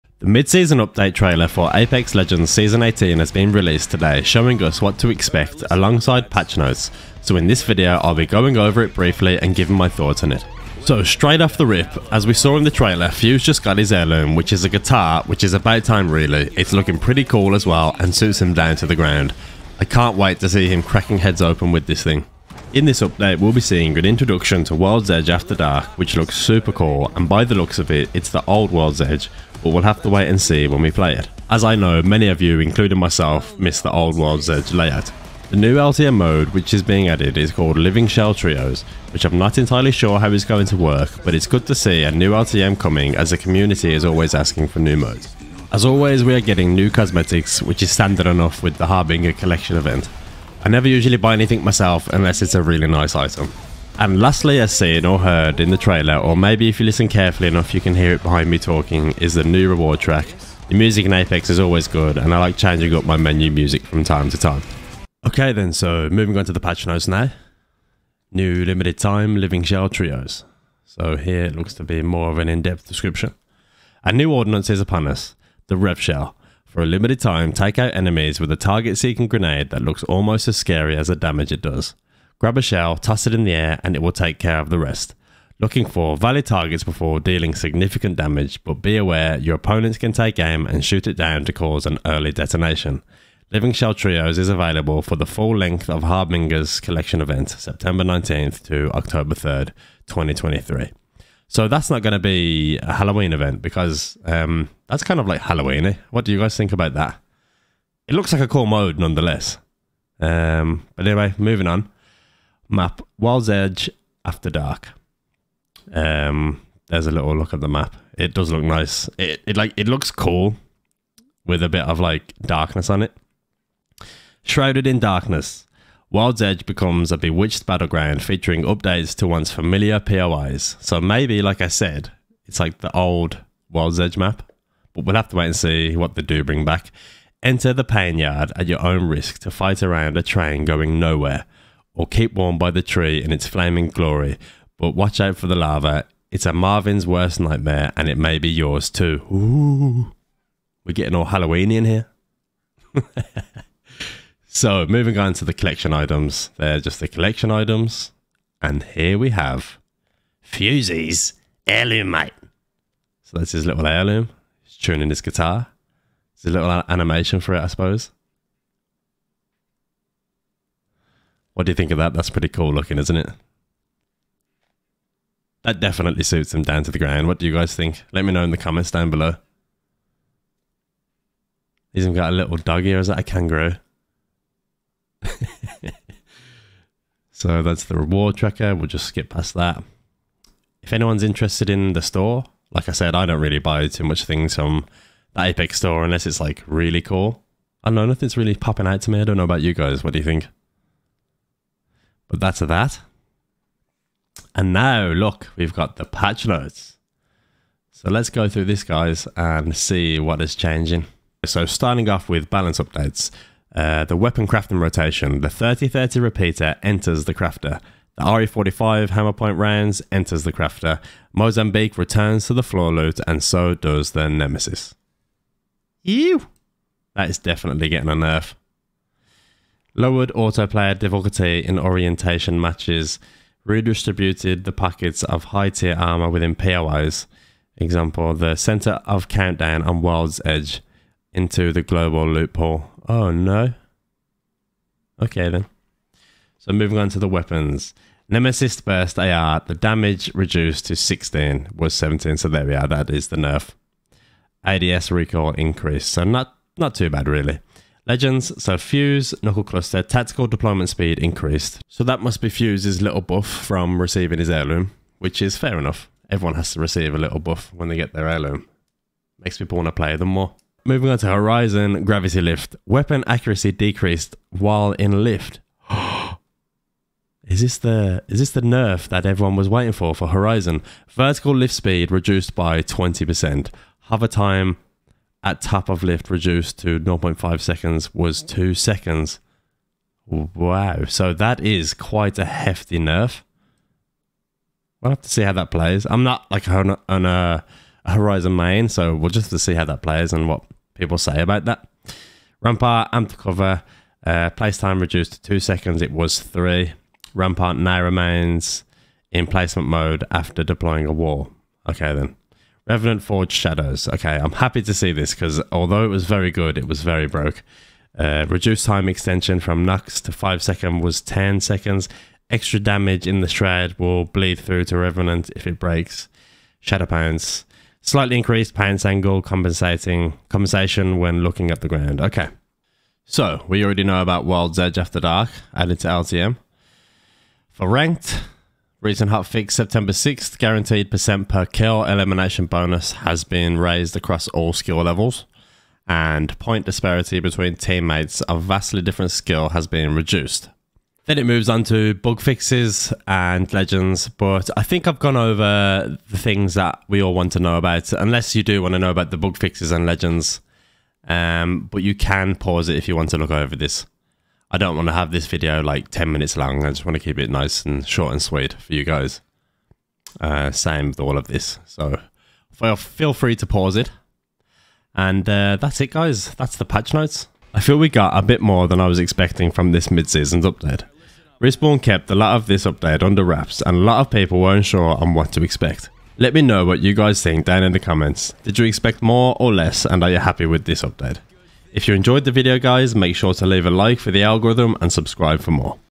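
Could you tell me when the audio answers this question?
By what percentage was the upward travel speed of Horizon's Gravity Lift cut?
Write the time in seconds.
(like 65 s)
282 s.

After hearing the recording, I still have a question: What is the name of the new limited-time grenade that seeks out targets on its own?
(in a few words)
Rev Shell.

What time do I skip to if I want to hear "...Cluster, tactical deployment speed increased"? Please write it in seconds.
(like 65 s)
259 s.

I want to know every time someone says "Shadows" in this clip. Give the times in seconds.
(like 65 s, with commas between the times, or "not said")
313 s, 326 s.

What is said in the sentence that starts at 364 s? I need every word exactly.
I don't want to have this video like 10 minutes long.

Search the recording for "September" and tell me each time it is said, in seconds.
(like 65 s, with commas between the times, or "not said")
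97 s, 339 s.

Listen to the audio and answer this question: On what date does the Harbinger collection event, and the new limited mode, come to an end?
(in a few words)
October 3rd, 2023.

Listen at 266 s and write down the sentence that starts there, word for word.
Everyone has to receive a little buff when they get their heirloom.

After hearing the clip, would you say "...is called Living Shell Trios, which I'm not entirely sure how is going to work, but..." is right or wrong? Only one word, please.
right.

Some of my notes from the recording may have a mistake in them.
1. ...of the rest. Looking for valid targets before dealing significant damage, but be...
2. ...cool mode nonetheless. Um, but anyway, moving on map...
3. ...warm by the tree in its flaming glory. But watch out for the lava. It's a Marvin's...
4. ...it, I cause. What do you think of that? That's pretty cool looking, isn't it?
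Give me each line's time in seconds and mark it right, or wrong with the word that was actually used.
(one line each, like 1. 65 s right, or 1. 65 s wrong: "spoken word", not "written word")
1. 84 s right
2. 108 s right
3. 142 s right
4. 167 s wrong: "suppose", not "cause".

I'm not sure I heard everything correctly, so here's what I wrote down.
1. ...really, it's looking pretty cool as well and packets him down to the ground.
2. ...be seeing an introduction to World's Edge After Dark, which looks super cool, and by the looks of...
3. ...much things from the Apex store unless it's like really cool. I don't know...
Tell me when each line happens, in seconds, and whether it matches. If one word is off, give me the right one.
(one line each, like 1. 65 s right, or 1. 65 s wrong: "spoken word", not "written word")
1. 16 s wrong: "suits", not "packets"
2. 23 s right
3. 194 s right.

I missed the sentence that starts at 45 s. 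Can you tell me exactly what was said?
As always, we are getting new cosmetics, which is standard enough with the Harbinger collection event.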